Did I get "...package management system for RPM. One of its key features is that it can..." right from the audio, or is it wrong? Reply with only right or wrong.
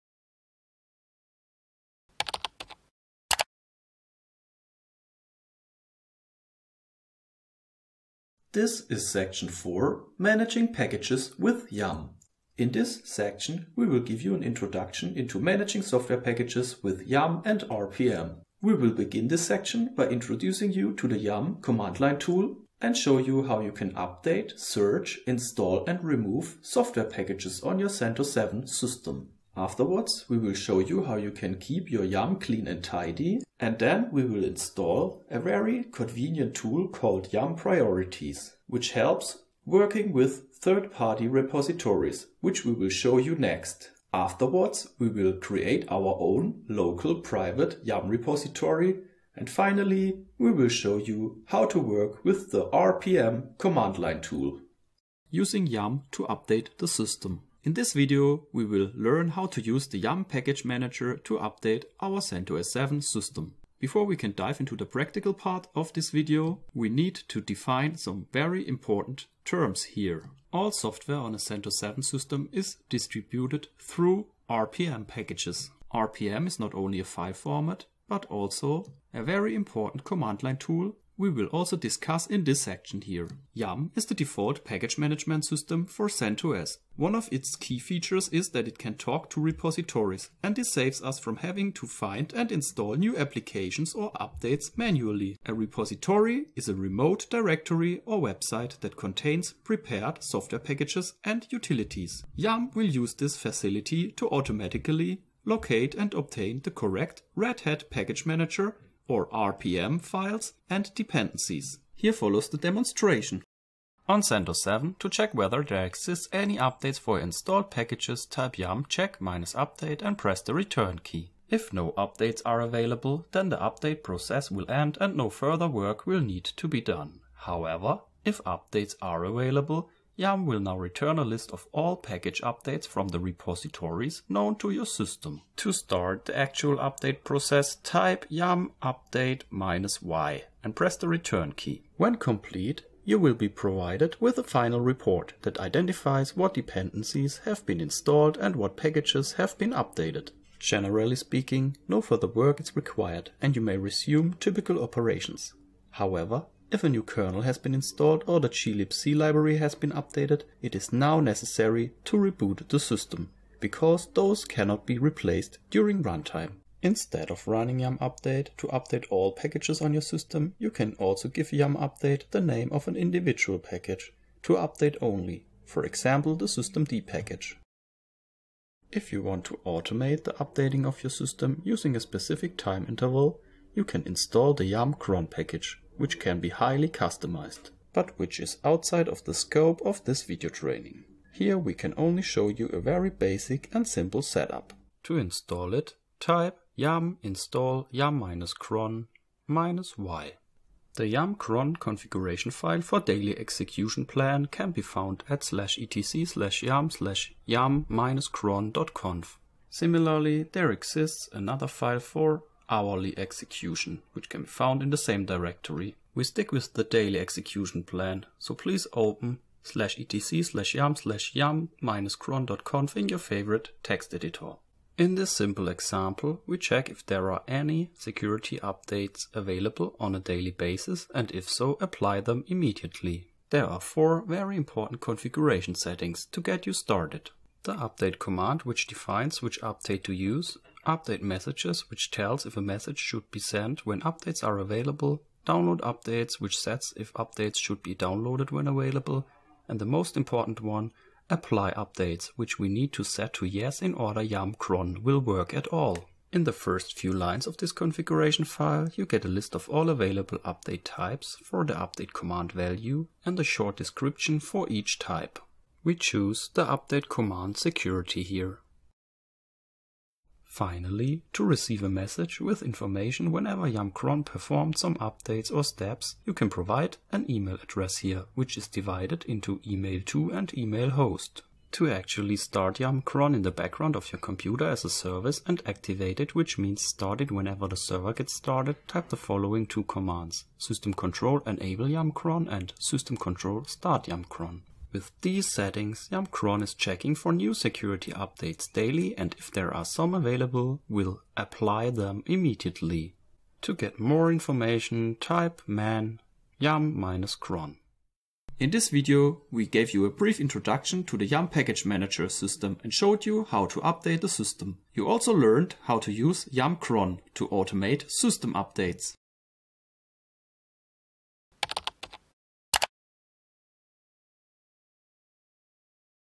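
wrong.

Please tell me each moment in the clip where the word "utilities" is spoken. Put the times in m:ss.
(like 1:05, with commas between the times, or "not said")
1:41.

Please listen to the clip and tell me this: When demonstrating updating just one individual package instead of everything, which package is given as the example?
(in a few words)
systemd.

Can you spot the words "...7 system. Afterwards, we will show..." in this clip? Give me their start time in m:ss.
0:28.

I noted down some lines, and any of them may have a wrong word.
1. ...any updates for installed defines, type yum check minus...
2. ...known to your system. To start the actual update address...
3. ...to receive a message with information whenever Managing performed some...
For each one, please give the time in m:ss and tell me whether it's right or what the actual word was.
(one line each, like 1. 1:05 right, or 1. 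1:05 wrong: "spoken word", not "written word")
1. 1:56 wrong: "packages", not "defines"
2. 2:14 wrong: "process", not "address"
3. 4:31 wrong: "YumCron", not "Managing".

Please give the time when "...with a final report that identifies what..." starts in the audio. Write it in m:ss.
2:24.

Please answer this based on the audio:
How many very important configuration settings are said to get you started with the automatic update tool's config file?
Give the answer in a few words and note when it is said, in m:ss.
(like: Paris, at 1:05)
4, at 3:53.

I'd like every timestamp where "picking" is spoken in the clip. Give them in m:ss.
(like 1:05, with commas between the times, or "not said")
not said.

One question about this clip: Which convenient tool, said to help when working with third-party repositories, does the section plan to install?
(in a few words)
YUM Priorities.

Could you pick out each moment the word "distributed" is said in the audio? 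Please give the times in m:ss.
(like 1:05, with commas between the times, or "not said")
1:12.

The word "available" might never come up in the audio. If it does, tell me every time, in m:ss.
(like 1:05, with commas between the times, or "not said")
2:02, 2:09, 3:49, 4:04, 4:08, 4:19, 5:00.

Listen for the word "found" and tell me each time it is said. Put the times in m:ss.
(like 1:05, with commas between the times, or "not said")
3:24, 3:34.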